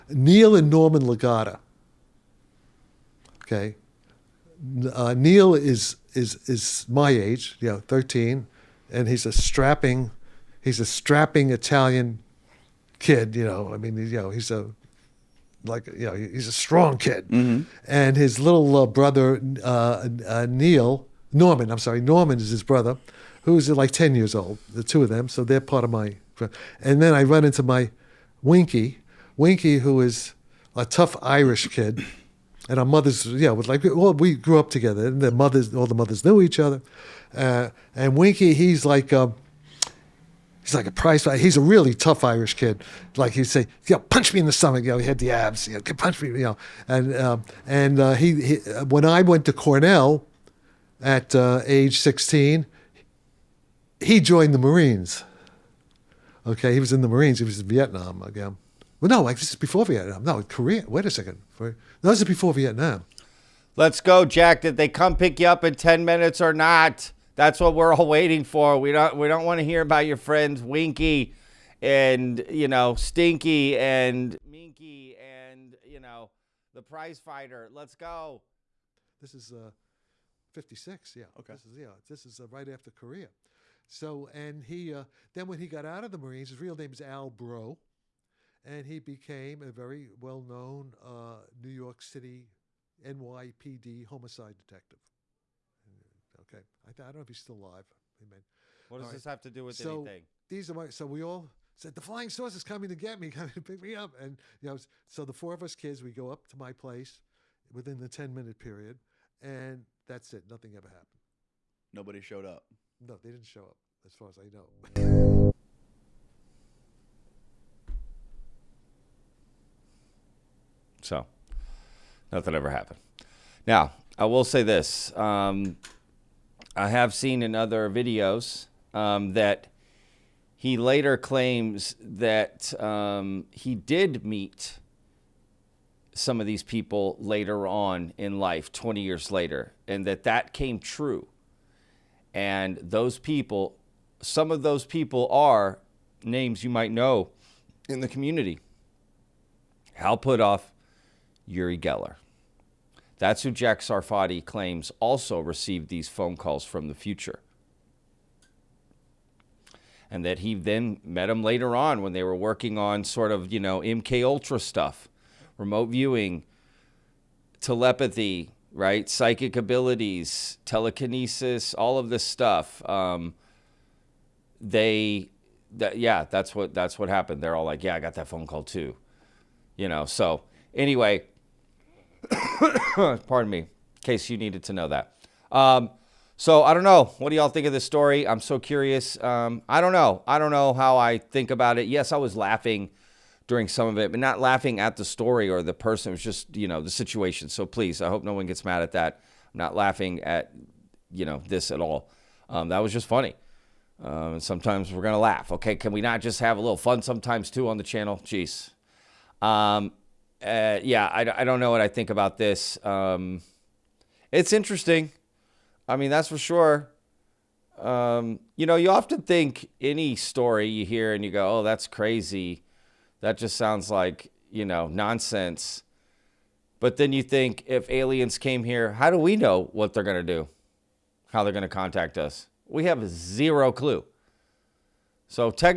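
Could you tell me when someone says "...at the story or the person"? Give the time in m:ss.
3:14.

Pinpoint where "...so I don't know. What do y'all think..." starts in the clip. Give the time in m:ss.
3:06.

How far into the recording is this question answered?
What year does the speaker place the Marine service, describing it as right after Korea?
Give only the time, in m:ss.
1:20.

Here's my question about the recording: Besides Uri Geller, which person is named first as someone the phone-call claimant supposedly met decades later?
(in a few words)
Hal Puthoff.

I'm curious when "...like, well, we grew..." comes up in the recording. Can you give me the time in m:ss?
0:33.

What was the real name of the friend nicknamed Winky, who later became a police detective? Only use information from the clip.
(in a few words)
Al Bro.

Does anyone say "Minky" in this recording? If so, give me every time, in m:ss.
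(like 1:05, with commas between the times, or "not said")
1:14.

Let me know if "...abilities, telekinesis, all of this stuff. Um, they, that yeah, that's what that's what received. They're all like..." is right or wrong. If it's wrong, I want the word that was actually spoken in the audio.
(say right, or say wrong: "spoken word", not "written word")
wrong: "happened", not "received".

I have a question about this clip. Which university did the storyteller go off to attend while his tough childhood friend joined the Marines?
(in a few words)
Cornell.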